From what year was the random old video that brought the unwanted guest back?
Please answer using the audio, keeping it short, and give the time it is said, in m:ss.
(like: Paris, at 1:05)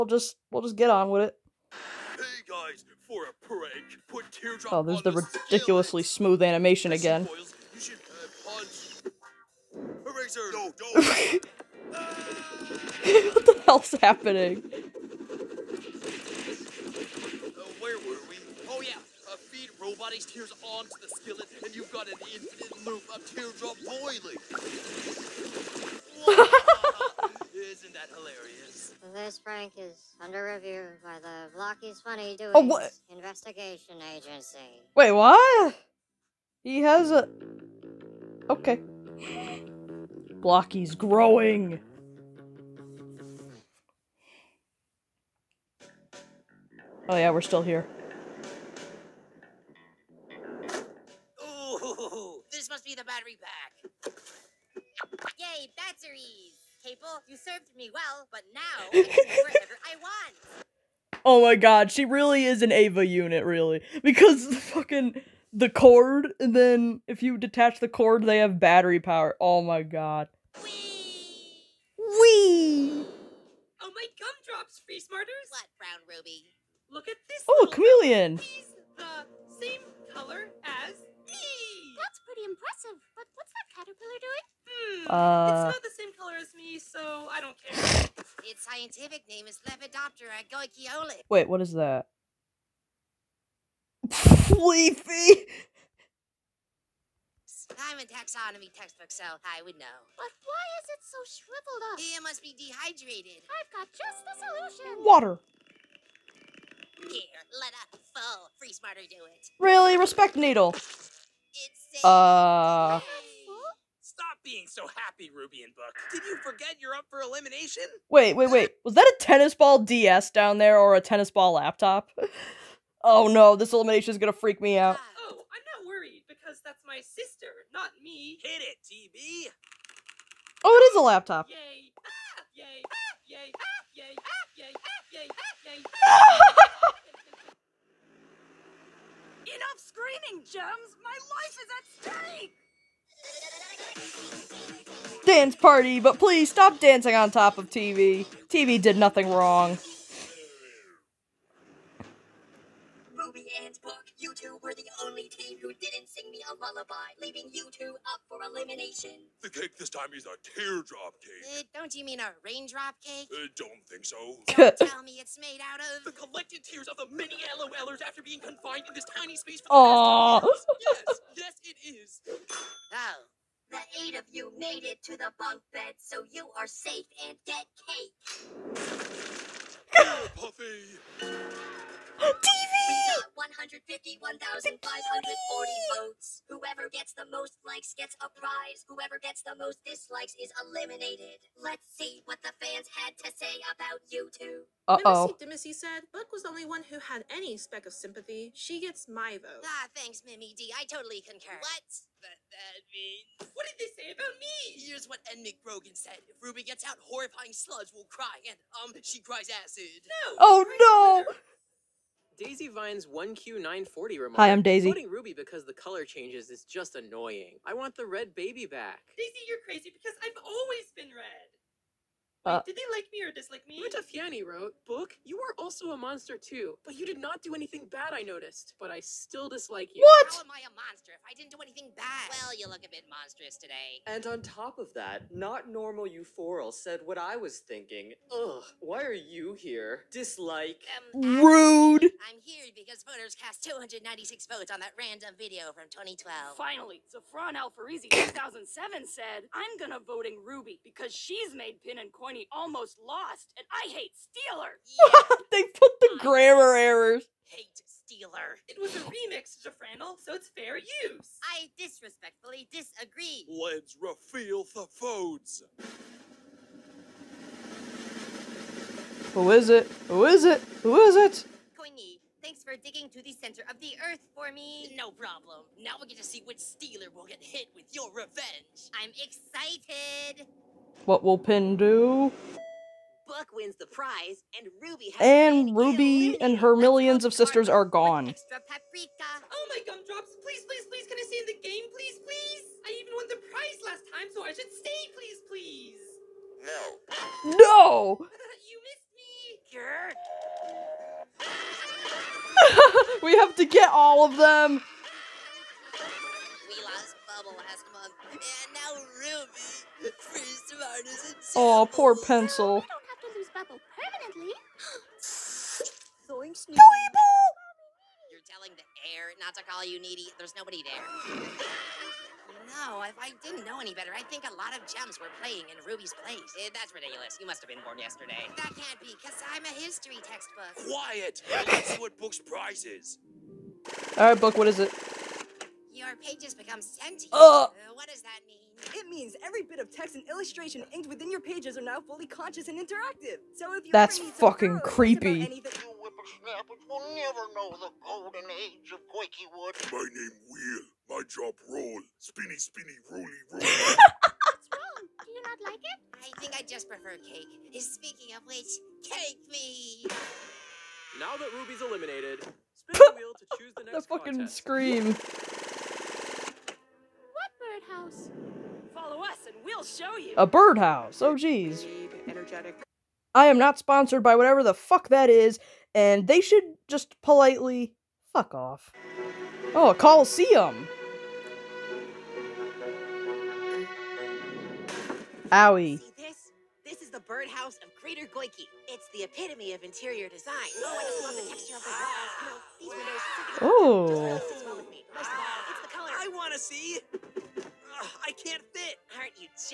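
2012, at 4:05.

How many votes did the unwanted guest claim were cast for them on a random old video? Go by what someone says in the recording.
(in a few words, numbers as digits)
296.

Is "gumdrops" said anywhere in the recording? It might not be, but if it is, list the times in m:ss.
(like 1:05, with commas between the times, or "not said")
1:14, 4:49.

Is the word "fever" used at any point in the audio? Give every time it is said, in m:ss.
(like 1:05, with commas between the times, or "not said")
not said.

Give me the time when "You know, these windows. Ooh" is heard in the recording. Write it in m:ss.
6:32.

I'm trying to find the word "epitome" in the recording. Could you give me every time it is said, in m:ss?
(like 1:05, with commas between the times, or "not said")
6:29.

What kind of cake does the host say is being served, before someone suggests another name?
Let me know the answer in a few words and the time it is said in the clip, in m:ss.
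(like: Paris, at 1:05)
teardrop cake, at 2:40.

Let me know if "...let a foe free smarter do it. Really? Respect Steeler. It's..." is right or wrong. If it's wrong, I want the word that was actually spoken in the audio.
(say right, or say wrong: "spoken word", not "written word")
wrong: "Needle", not "Steeler".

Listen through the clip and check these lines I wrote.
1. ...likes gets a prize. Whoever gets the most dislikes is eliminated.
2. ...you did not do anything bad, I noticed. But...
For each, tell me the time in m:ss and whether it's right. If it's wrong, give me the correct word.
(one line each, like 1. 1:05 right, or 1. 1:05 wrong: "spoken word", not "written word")
1. 3:07 right
2. 3:46 right.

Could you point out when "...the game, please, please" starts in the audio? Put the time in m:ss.
4:51.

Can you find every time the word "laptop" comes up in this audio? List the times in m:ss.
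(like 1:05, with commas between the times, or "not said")
2:01, 2:11.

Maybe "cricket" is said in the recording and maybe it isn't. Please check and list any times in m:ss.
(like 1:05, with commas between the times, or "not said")
not said.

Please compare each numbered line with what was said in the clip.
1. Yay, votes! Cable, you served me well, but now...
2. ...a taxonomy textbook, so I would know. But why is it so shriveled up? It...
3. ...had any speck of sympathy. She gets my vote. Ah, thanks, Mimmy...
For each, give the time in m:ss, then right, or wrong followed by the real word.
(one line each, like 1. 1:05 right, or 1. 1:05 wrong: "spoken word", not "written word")
1. 0:55 wrong: "batteries", not "votes"
2. 1:37 right
3. 3:16 right.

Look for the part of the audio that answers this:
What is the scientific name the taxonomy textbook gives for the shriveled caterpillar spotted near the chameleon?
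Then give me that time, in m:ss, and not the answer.
1:29.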